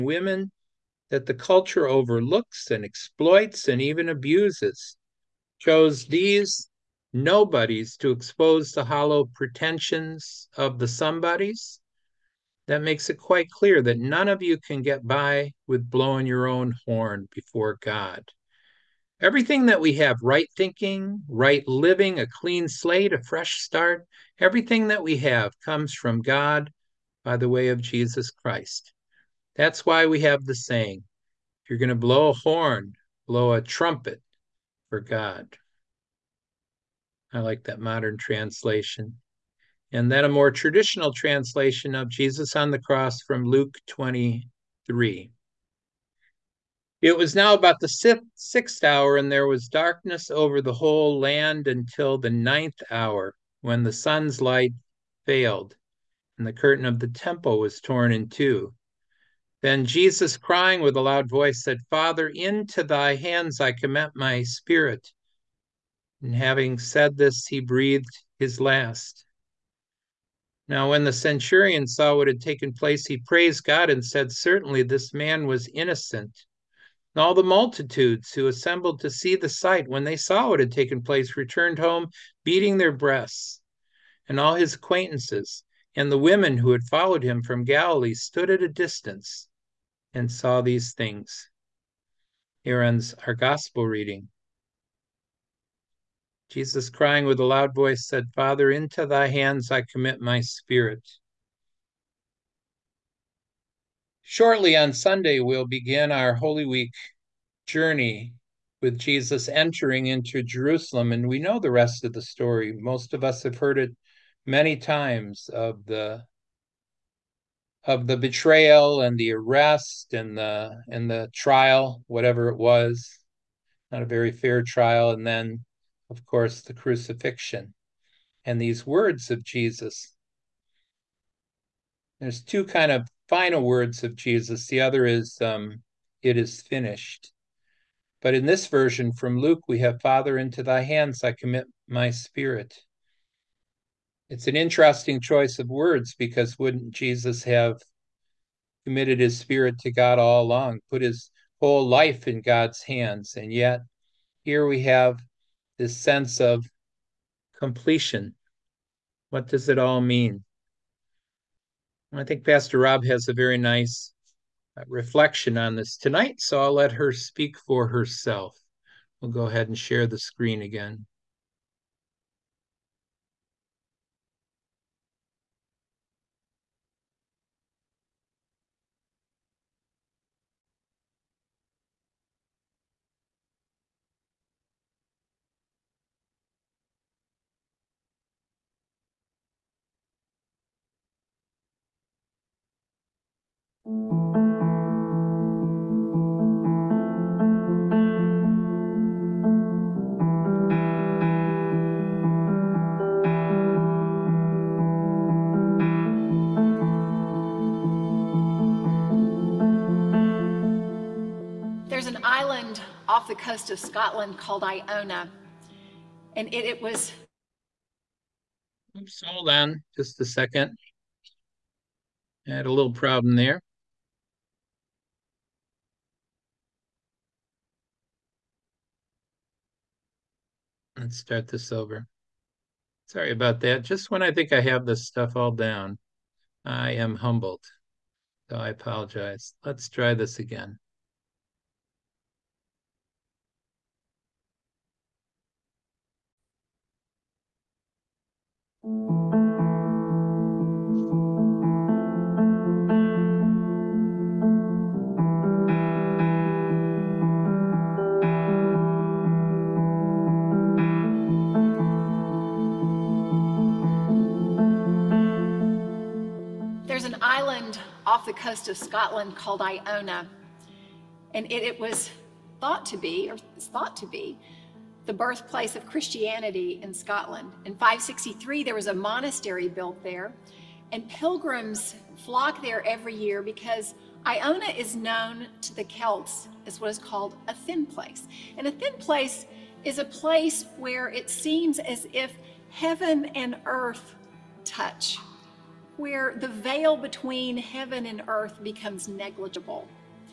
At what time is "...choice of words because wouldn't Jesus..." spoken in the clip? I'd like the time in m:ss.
2:25.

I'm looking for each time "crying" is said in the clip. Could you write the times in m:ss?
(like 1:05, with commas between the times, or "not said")
1:00, 1:36.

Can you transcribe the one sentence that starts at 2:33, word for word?
And yet, here we have this sense of completion.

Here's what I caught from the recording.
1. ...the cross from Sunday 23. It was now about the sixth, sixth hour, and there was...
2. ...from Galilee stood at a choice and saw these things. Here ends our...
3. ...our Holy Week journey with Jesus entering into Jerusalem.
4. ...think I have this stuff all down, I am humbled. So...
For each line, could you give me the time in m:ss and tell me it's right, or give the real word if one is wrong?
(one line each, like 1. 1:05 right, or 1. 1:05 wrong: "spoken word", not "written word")
1. 0:42 wrong: "Luke", not "Sunday"
2. 1:27 wrong: "distance", not "choice"
3. 1:46 right
4. 3:54 right.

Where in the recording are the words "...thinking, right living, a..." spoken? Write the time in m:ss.
0:20.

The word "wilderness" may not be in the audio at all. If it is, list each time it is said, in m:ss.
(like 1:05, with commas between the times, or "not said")
not said.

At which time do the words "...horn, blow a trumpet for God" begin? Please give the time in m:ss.
0:32.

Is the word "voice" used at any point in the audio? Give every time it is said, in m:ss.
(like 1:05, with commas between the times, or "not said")
1:01, 1:37.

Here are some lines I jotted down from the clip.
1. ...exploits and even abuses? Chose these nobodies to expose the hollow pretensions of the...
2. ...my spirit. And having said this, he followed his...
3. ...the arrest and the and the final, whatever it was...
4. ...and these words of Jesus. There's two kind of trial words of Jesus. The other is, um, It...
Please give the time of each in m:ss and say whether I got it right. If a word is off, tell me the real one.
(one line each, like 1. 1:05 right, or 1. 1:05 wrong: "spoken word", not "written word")
1. 0:02 right
2. 1:04 wrong: "breathed", not "followed"
3. 1:59 wrong: "trial", not "final"
4. 2:08 wrong: "final", not "trial".